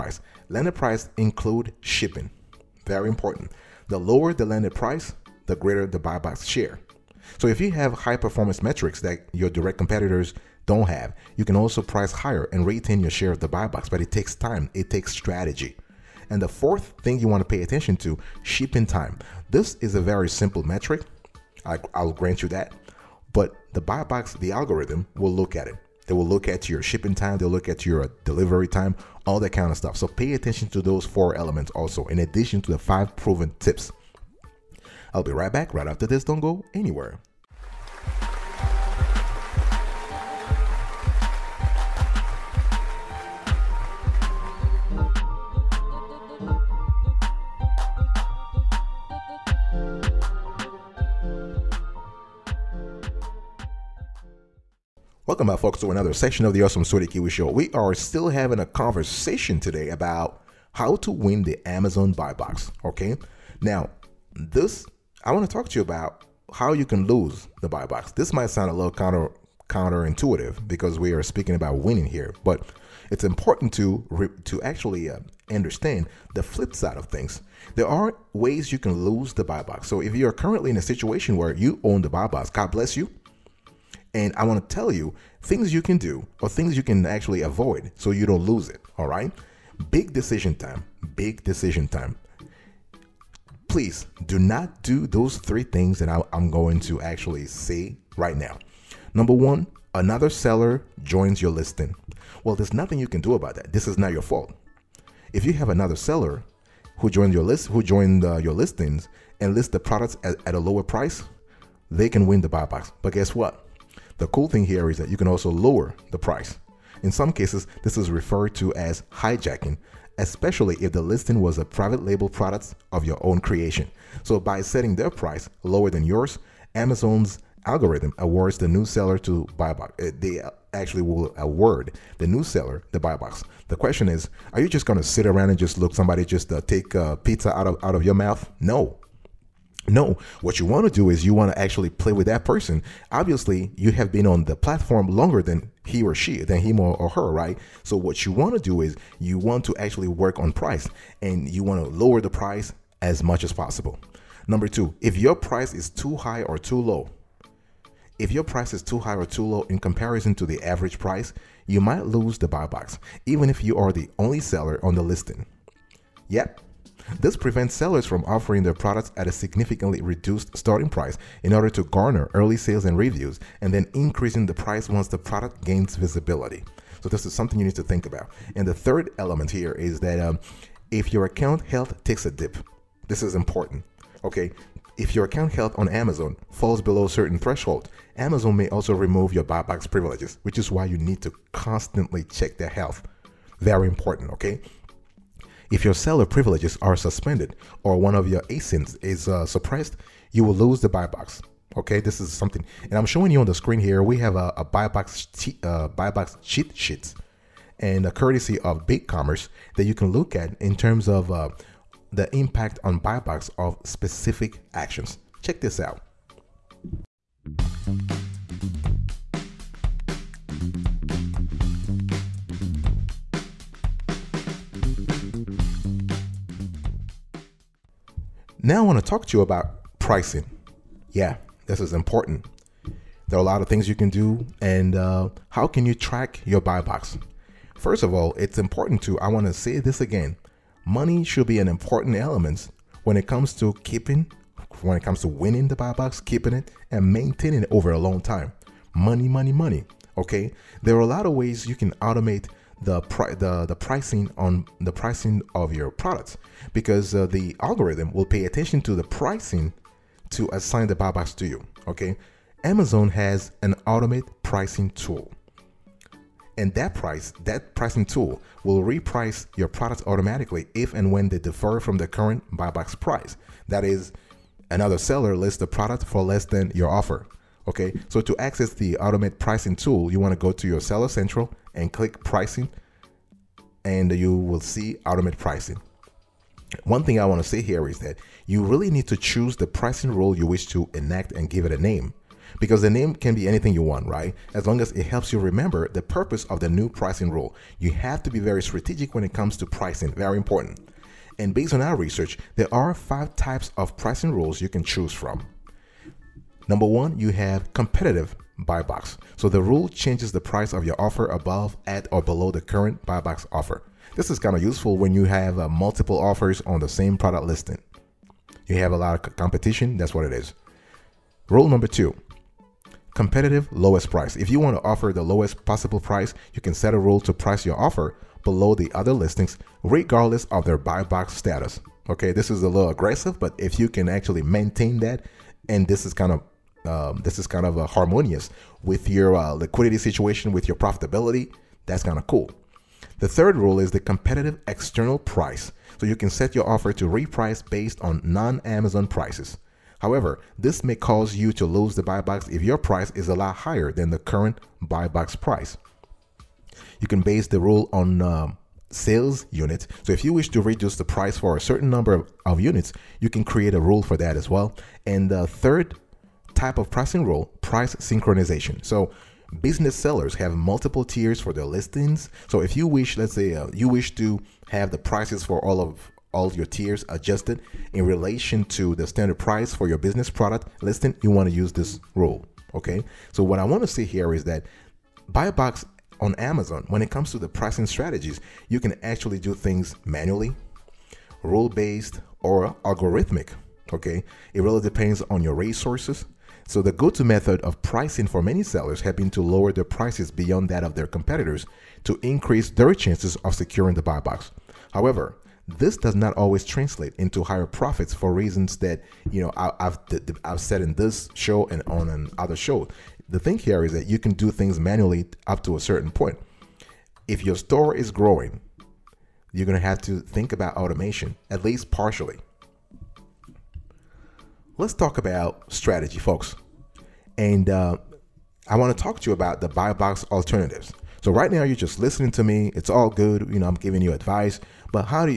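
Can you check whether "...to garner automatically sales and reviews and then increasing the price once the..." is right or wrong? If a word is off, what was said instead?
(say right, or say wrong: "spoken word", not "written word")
wrong: "early", not "automatically".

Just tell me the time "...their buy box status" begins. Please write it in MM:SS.
05:30.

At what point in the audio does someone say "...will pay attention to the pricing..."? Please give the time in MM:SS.
04:18.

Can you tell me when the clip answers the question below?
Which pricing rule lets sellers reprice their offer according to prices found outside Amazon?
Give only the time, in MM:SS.
05:43.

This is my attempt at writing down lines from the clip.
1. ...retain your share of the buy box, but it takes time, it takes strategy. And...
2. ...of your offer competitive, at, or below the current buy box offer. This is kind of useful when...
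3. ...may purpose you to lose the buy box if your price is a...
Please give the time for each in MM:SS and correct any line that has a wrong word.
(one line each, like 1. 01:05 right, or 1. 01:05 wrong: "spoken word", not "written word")
1. 00:12 right
2. 05:10 wrong: "above", not "competitive"
3. 05:50 wrong: "cause", not "purpose".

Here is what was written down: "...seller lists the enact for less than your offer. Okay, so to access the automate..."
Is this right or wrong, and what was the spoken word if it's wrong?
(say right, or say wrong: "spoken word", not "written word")
wrong: "product", not "enact".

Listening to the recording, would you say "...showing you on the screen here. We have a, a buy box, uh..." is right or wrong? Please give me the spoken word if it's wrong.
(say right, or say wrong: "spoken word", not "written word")
right.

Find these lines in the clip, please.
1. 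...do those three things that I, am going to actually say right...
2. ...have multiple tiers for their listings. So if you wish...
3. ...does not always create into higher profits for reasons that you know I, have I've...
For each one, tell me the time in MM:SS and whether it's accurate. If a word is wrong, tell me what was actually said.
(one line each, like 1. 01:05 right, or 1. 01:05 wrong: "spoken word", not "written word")
1. 01:34 right
2. 06:10 right
3. 06:45 wrong: "translate", not "create".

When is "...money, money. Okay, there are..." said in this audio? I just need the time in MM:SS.
04:09.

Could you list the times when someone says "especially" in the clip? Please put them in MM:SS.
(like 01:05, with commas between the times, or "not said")
02:00.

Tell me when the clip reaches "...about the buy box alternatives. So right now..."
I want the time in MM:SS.
07:09.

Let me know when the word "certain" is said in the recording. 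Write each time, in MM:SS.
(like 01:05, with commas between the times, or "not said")
03:07, 06:01, 06:55.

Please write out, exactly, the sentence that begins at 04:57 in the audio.
You have to be very strategic when it comes to pricing, very important.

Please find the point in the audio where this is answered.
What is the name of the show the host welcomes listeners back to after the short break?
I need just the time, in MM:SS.
00:56.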